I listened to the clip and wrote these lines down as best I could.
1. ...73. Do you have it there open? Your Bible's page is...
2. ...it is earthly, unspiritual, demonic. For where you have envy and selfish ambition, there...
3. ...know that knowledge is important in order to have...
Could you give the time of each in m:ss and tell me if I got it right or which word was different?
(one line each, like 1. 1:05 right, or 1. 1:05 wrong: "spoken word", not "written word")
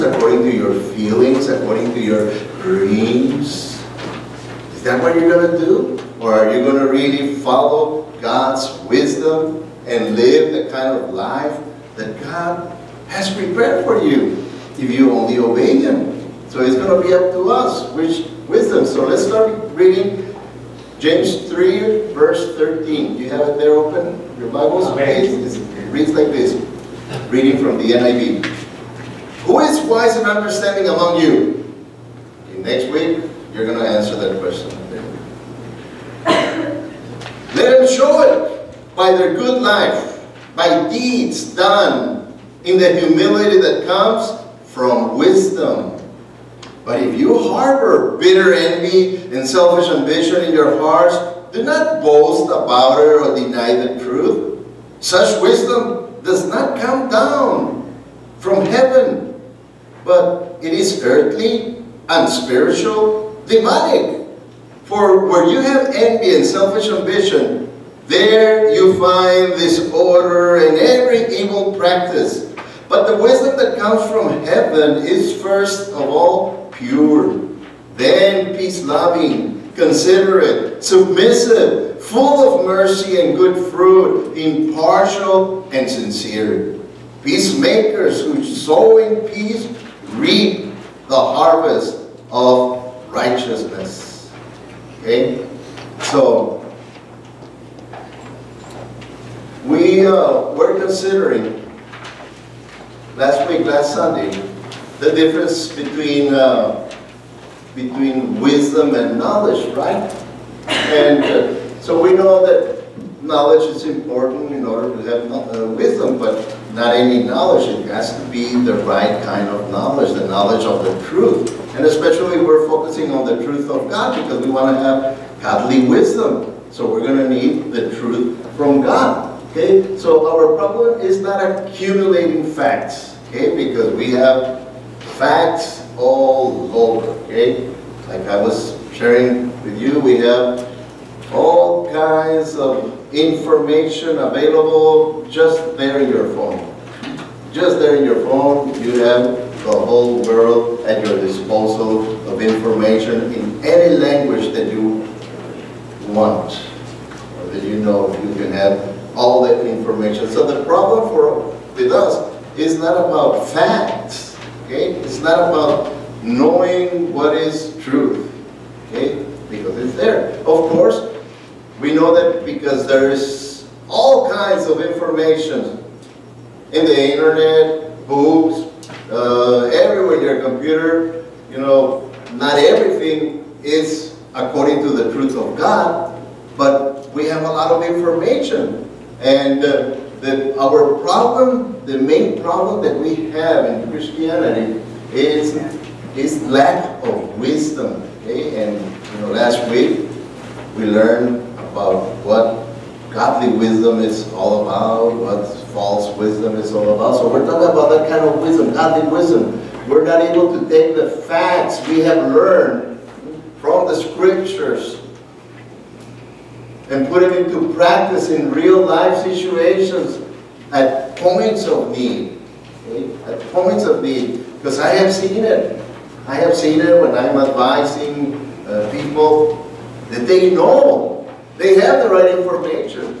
1. 0:22 wrong: "13", not "73"
2. 1:00 right
3. 1:52 right.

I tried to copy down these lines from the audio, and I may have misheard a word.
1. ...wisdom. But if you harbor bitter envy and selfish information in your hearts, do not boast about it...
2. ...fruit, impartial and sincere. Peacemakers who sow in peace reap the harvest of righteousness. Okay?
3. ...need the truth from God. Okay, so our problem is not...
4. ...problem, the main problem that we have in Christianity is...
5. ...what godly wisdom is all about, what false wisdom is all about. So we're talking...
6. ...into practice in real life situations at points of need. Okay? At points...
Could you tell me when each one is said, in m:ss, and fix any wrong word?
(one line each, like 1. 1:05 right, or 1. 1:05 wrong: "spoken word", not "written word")
1. 0:45 wrong: "ambition", not "information"
2. 1:23 right
3. 2:07 right
4. 3:10 right
5. 3:22 right
6. 3:37 right.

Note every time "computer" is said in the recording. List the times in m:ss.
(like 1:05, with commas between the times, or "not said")
3:00.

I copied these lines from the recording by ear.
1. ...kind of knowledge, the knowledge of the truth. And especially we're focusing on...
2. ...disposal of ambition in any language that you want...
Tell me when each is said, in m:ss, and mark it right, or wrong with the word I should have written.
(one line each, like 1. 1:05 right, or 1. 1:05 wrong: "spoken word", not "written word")
1. 1:59 right
2. 2:31 wrong: "information", not "ambition".